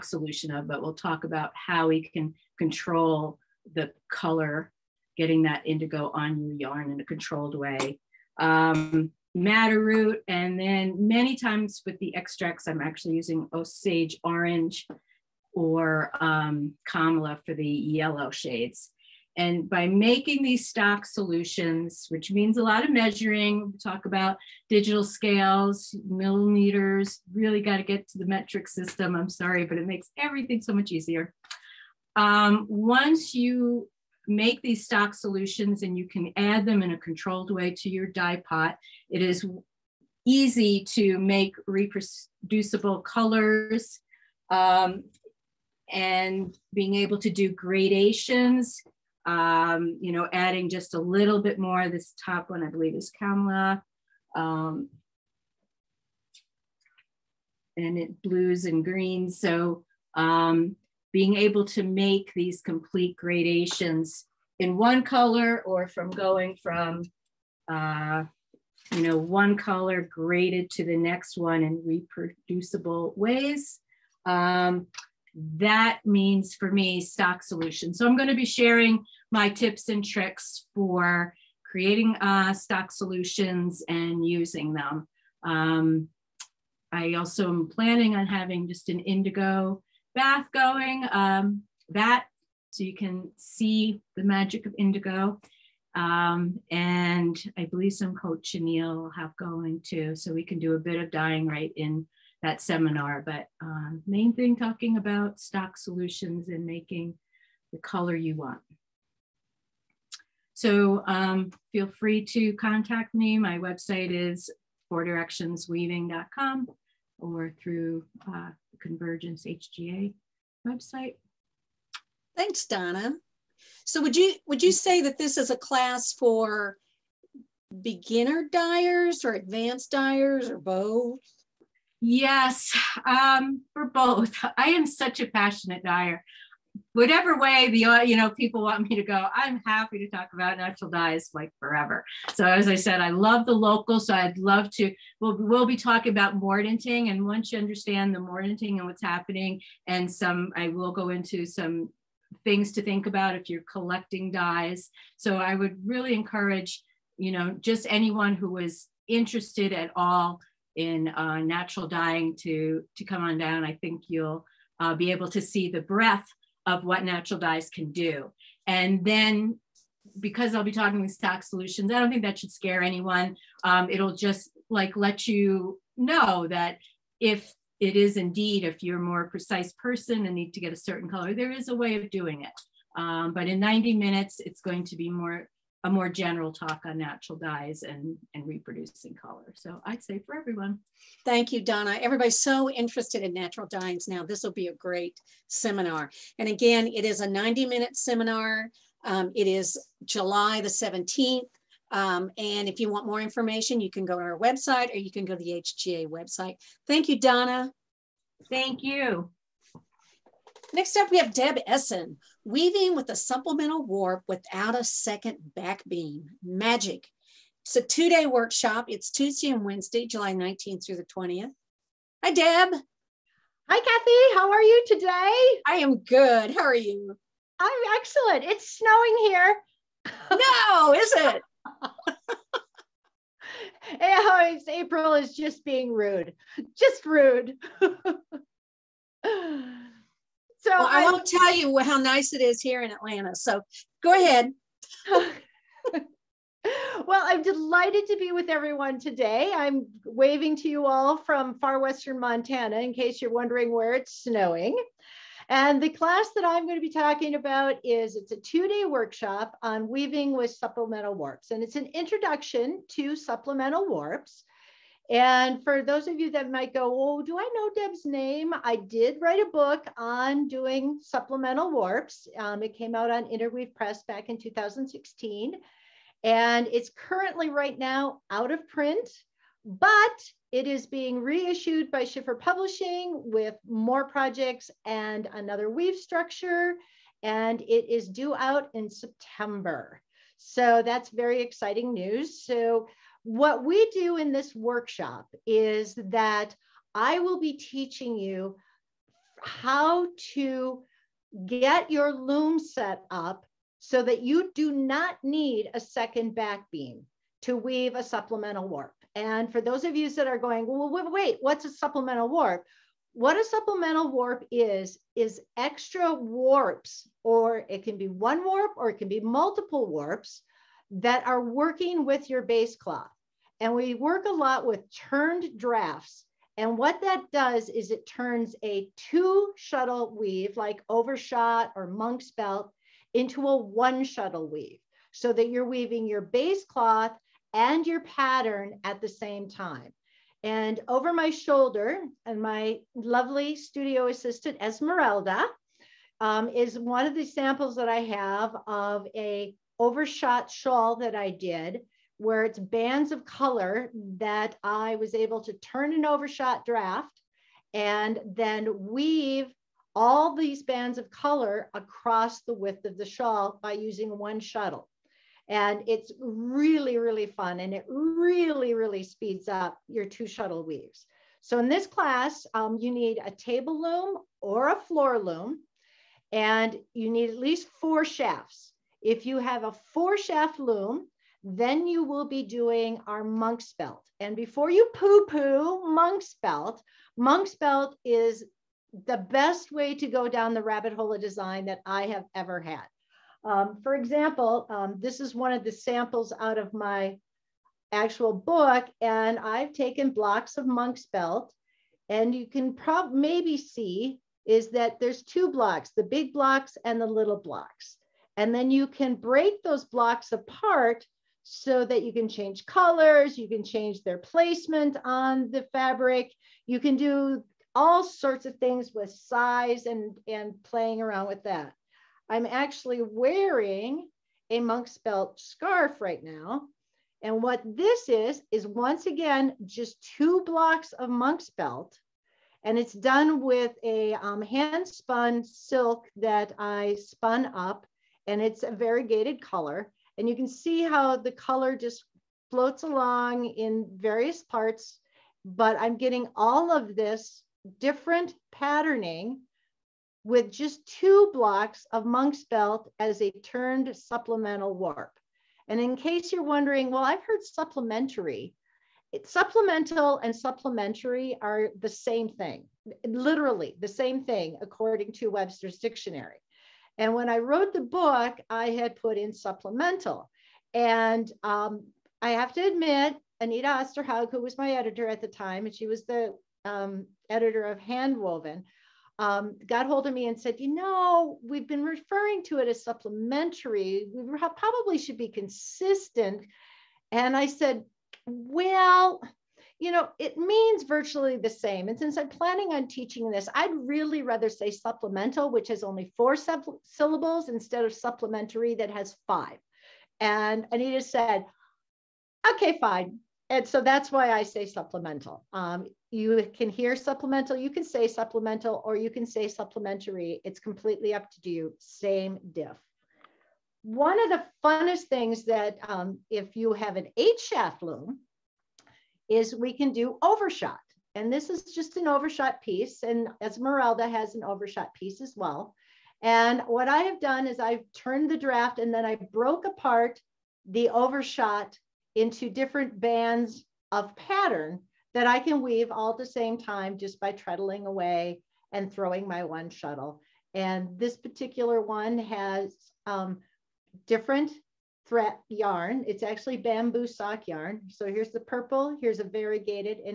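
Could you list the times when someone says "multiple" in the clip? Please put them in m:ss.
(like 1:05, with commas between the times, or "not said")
5:19.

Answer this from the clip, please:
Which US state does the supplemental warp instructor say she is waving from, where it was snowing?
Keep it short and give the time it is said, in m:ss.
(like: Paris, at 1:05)
Montana, at 4:12.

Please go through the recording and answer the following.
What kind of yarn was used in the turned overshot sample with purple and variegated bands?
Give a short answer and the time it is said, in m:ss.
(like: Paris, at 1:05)
bamboo sock yarn, at 9:06.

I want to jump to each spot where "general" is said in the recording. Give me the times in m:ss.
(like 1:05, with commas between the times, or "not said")
3:06.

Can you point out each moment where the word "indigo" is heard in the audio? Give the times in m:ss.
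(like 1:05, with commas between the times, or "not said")
0:05, 1:28, 1:34.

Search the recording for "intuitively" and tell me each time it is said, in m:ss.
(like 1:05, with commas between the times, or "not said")
not said.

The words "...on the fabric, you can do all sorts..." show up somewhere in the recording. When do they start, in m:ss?
6:55.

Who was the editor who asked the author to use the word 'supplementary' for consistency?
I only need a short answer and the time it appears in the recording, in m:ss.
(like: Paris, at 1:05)
Anita Osterhaug, at 7:53.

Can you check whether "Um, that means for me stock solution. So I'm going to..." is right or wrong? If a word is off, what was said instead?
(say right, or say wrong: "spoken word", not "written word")
right.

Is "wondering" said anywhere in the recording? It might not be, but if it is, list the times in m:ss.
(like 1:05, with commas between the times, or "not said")
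4:13, 7:36.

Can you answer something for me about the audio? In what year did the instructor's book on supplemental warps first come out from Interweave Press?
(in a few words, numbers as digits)
2016.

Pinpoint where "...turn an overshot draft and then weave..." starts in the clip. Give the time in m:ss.
5:55.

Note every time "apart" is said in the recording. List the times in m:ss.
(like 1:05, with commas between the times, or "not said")
6:50, 8:49.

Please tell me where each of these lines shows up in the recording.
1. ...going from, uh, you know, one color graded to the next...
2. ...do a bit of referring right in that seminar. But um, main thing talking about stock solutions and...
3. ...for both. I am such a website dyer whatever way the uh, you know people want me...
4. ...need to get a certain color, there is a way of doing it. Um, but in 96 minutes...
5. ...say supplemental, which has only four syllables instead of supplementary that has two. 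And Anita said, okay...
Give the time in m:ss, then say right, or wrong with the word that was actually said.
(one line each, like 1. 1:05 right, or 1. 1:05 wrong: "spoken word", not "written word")
1. 1:06 right
2. 1:40 wrong: "dyeing", not "referring"
3. 2:13 wrong: "passionate", not "website"
4. 3:00 wrong: "90", not "96"
5. 8:14 wrong: "five", not "two".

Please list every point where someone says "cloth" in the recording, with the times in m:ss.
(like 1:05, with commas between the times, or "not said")
5:22, 5:36.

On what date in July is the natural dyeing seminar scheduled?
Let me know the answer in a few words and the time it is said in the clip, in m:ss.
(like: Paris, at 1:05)
July 17, at 3:20.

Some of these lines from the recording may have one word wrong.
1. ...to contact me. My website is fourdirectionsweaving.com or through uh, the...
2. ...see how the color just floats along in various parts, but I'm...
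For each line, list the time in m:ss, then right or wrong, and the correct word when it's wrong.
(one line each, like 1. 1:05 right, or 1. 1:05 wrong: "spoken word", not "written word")
1. 1:52 right
2. 7:20 right.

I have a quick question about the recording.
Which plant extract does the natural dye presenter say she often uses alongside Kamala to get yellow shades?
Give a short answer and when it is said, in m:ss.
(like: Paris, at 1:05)
Osage orange, at 0:13.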